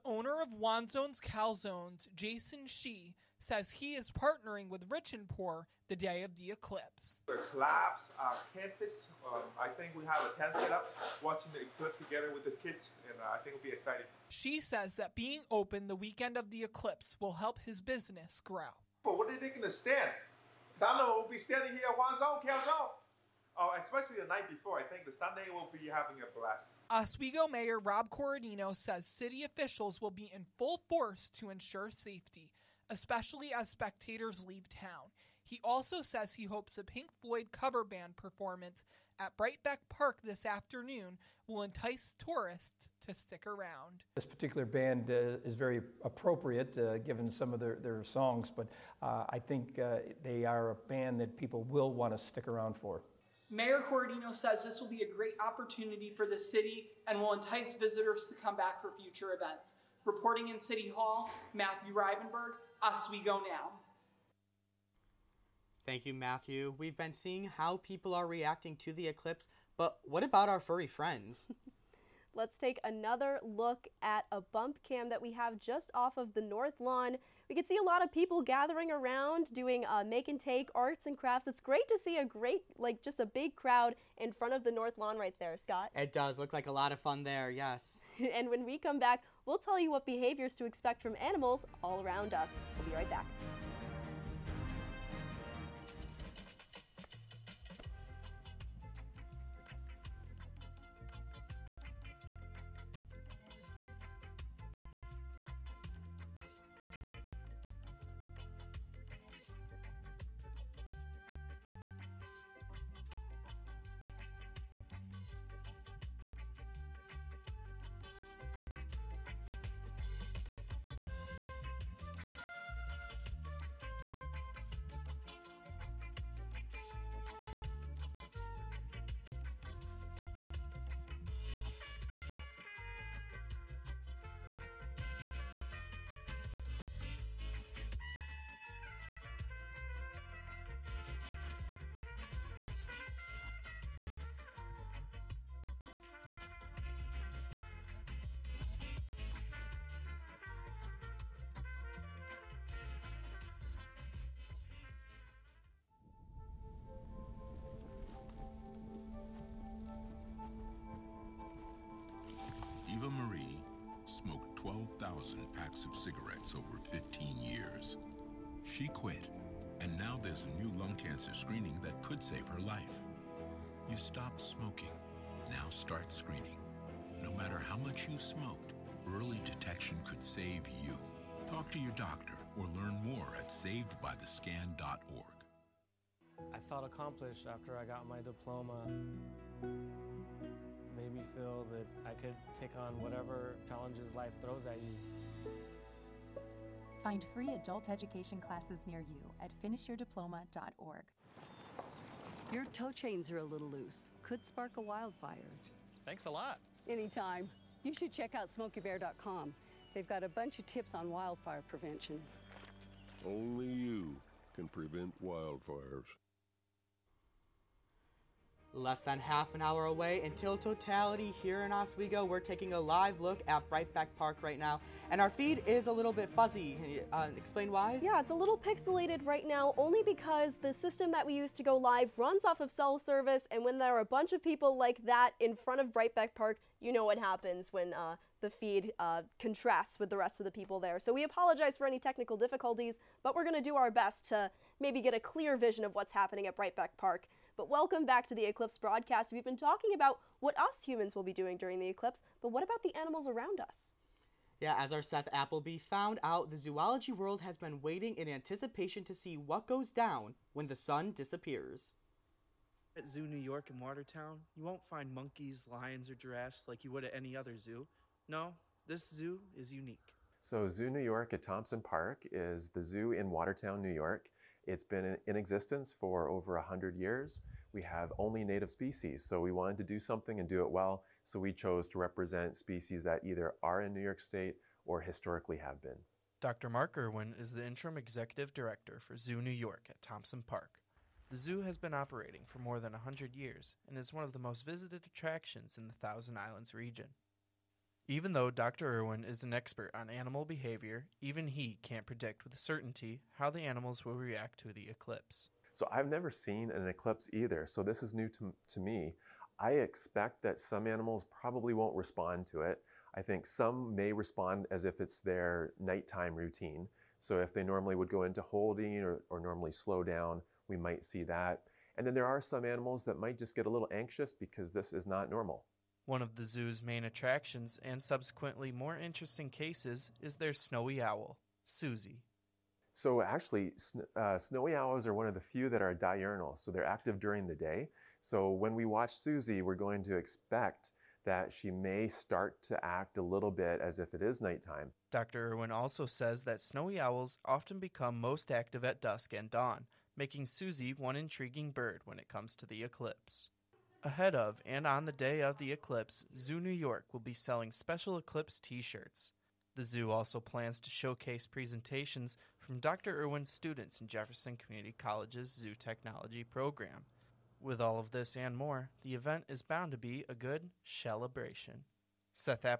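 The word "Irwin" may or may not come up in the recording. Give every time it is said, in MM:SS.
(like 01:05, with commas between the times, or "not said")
04:46, 04:58, 05:45, 06:03.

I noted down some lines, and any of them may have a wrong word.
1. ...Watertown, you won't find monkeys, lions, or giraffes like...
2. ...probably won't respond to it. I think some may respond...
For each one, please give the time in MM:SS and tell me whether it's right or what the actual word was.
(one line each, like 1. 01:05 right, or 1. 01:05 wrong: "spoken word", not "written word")
1. 04:23 right
2. 05:11 right.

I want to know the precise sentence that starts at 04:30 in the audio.
So, Zoo New York at Thompson Park is the zoo in Watertown, New York.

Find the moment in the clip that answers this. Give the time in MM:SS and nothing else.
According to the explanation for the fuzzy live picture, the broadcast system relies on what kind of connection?
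03:52.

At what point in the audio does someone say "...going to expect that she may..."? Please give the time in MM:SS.
05:39.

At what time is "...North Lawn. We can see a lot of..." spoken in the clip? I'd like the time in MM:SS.
01:16.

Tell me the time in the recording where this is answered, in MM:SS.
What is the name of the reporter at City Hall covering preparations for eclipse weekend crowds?
01:01.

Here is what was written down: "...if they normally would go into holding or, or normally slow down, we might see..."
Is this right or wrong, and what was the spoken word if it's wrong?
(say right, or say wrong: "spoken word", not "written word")
right.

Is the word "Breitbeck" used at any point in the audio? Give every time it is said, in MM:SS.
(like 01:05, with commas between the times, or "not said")
00:39, 03:43, 03:55, 04:06.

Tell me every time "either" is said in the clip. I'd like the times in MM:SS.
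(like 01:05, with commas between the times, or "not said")
04:43, 05:07.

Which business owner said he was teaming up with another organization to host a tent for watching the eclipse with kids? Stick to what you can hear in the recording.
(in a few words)
Jason Shee.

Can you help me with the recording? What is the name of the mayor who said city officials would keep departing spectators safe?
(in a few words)
Rob Corradino.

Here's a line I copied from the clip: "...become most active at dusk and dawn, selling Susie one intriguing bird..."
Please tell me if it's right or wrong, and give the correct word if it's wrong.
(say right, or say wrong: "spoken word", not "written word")
wrong: "making", not "selling".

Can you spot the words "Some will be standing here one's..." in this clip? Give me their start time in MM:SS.
00:20.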